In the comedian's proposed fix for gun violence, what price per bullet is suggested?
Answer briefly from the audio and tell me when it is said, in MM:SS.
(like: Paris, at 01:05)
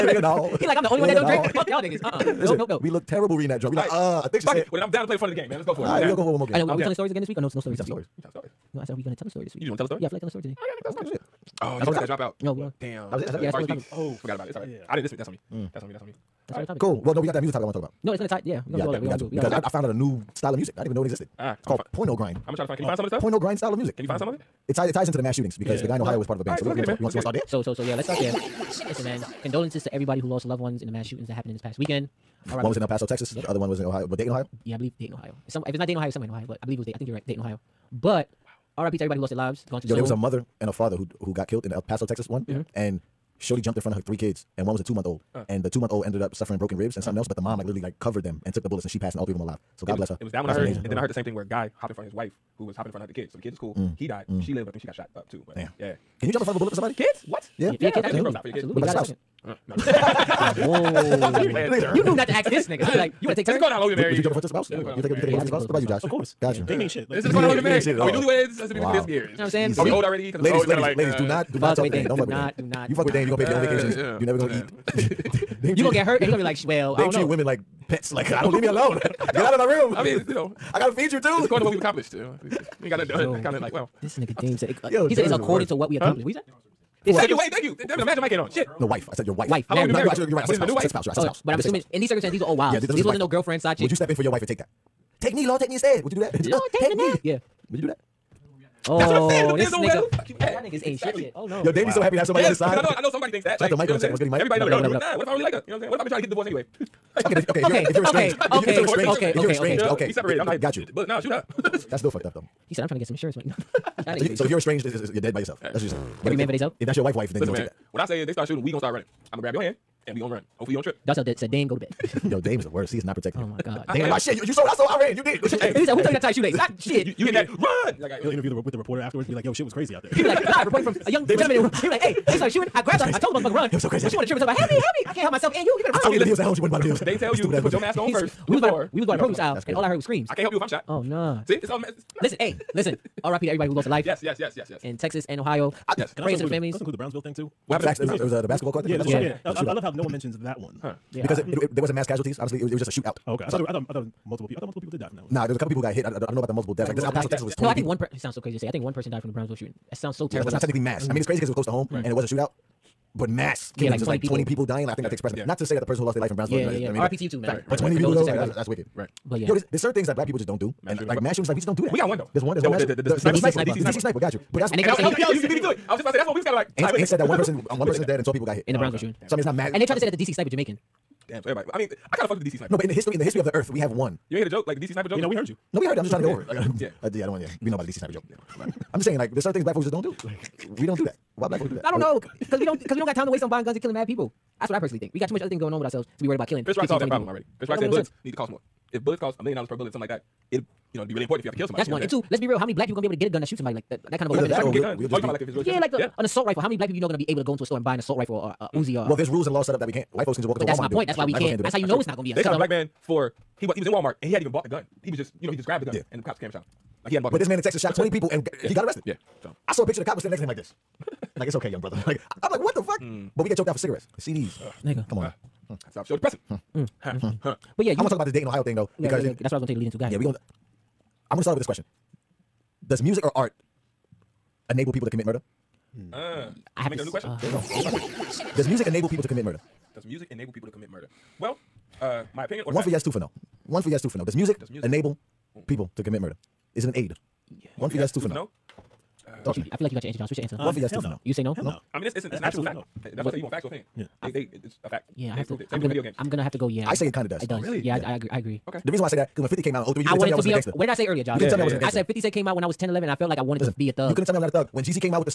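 a million dollars, at 03:19.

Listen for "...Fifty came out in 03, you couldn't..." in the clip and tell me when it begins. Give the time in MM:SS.
04:19.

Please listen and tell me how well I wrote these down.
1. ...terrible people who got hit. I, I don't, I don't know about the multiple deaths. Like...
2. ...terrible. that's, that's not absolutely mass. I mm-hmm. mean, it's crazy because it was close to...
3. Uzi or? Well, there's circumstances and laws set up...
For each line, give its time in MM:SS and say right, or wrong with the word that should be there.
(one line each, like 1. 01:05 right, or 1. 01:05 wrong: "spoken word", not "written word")
1. 02:35 wrong: "couple", not "terrible"
2. 02:40 wrong: "technically", not "absolutely"
3. 03:28 wrong: "rules", not "circumstances".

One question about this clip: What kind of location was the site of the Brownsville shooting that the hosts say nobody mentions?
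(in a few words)
basketball court.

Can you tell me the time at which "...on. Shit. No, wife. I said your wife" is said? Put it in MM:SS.
01:28.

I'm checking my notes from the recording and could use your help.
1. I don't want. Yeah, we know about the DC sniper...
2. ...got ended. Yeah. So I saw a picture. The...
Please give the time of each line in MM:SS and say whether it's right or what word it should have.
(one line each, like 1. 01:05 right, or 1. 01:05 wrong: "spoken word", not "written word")
1. 03:07 right
2. 03:38 wrong: "arrested", not "ended".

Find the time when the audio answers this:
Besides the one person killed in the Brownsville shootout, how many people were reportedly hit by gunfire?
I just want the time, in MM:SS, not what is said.
02:58.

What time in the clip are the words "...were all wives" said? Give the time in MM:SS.
01:32.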